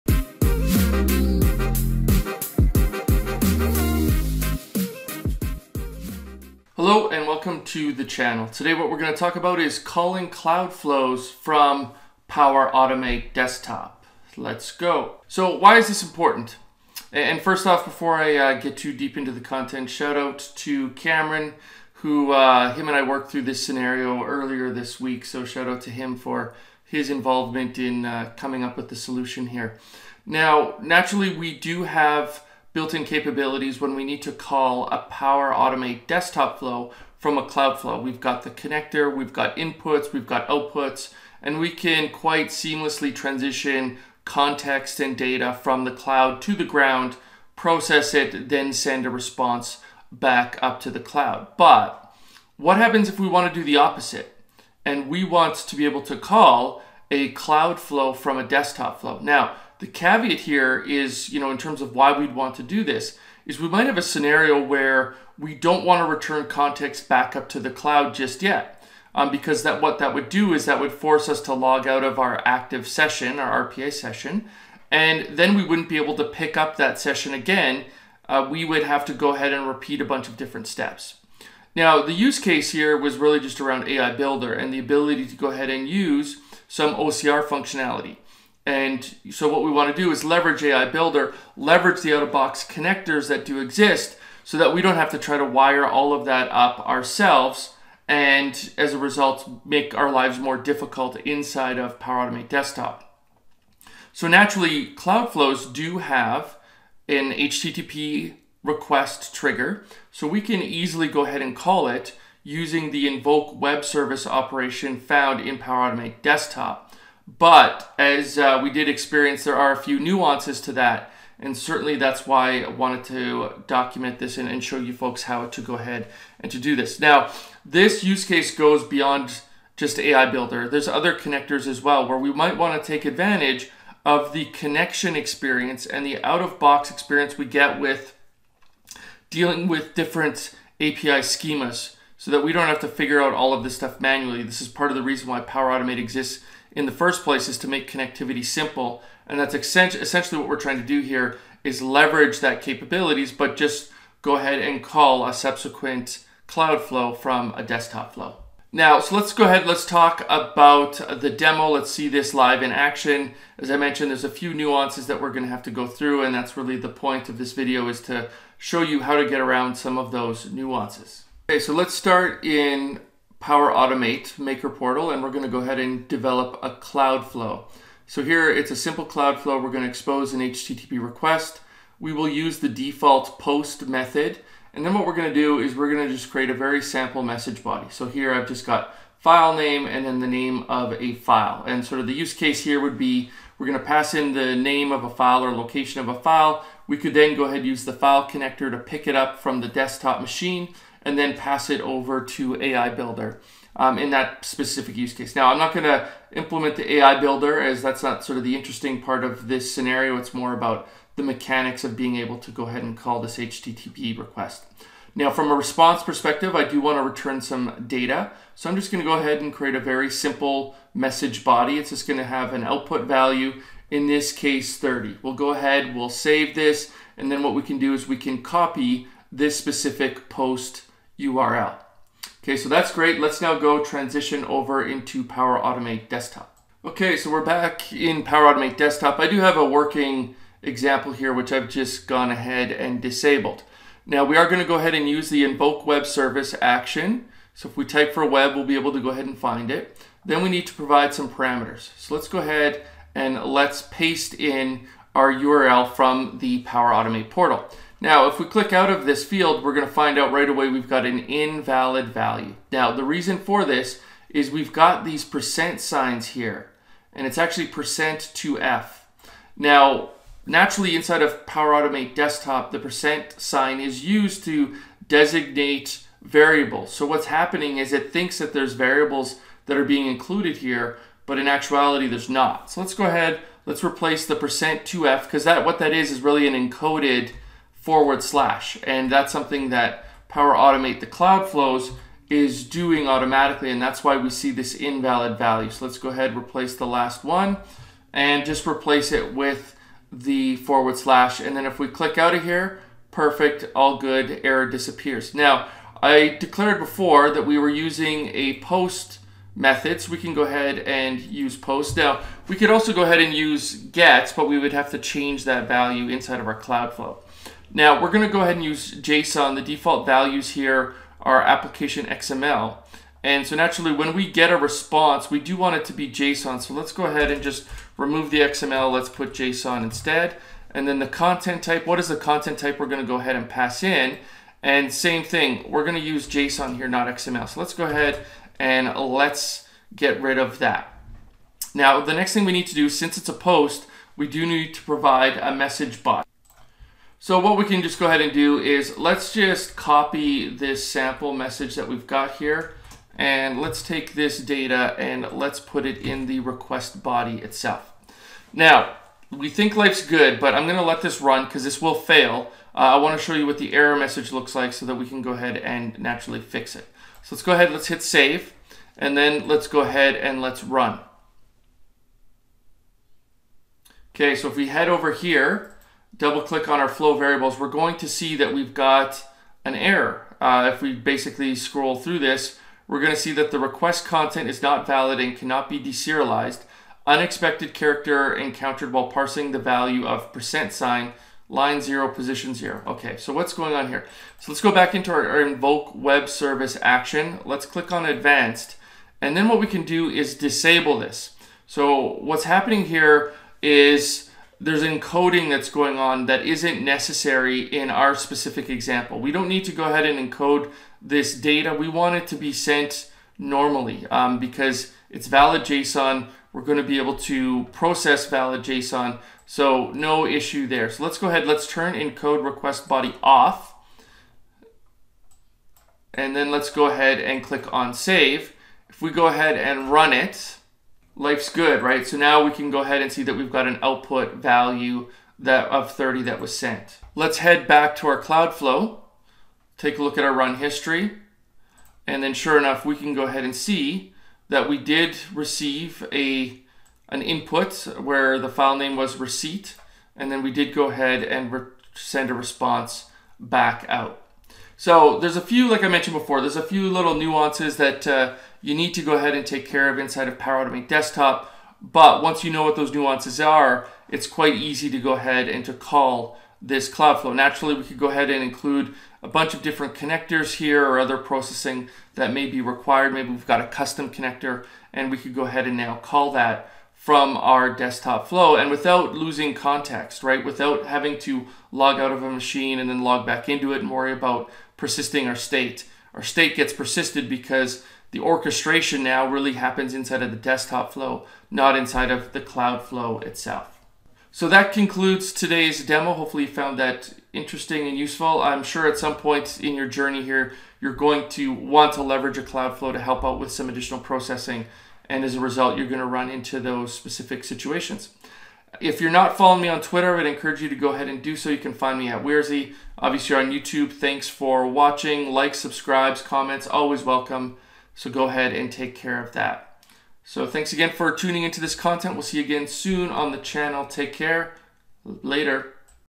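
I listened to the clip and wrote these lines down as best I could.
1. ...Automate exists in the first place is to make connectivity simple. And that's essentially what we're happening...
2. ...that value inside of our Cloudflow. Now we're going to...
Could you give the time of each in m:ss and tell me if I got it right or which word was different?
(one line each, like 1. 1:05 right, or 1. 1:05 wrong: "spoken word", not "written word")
1. 2:25 wrong: "trying", not "happening"
2. 5:15 right.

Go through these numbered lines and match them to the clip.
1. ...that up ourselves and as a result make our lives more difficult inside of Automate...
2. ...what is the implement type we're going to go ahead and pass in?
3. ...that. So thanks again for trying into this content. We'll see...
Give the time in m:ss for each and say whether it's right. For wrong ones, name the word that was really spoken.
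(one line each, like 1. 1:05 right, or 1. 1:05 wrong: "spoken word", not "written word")
1. 1:36 wrong: "Power", not "Automate"
2. 5:31 wrong: "content", not "implement"
3. 8:39 wrong: "tuning", not "trying".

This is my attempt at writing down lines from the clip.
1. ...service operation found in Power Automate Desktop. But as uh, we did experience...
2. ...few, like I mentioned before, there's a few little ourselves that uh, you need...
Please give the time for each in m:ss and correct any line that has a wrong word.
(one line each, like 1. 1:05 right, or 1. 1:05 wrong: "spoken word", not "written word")
1. 1:53 right
2. 7:35 wrong: "nuances", not "ourselves".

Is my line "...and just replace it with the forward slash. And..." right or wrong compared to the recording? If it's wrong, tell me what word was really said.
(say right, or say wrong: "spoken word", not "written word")
right.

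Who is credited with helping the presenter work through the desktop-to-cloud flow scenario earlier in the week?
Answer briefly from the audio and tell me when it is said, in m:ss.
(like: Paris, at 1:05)
Cameron, at 0:20.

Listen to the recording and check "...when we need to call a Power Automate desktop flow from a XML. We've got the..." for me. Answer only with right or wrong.
wrong.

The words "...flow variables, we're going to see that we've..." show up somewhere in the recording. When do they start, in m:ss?
6:16.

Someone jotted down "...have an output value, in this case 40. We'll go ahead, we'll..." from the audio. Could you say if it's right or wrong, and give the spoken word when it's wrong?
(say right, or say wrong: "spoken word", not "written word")
wrong: "30", not "40".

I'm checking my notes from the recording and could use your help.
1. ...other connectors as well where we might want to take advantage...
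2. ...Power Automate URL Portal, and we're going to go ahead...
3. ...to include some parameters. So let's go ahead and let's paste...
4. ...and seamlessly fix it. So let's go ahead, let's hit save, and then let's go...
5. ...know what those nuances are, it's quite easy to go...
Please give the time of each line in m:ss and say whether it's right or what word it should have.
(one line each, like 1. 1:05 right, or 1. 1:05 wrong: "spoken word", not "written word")
1. 2:10 right
2. 2:53 wrong: "Maker", not "URL"
3. 4:10 wrong: "provide", not "include"
4. 6:05 wrong: "naturally", not "seamlessly"
5. 7:42 right.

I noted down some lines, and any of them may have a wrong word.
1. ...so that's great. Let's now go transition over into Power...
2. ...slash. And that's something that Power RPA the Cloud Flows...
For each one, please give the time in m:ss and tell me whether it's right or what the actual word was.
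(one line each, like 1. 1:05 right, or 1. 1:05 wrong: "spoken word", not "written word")
1. 3:52 right
2. 4:48 wrong: "Automate", not "RPA".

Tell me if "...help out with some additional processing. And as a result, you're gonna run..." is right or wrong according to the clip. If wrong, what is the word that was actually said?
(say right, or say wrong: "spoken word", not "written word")
right.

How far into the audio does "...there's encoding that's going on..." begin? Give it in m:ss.
6:44.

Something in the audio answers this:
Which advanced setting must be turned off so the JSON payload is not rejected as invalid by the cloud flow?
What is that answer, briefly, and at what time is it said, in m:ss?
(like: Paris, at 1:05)
Encode request body, at 7:01.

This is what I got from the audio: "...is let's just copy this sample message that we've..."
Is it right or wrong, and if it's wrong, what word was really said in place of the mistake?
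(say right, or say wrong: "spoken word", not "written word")
right.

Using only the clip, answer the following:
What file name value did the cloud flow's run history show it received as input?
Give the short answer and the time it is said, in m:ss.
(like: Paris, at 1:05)
Receipt, at 7:29.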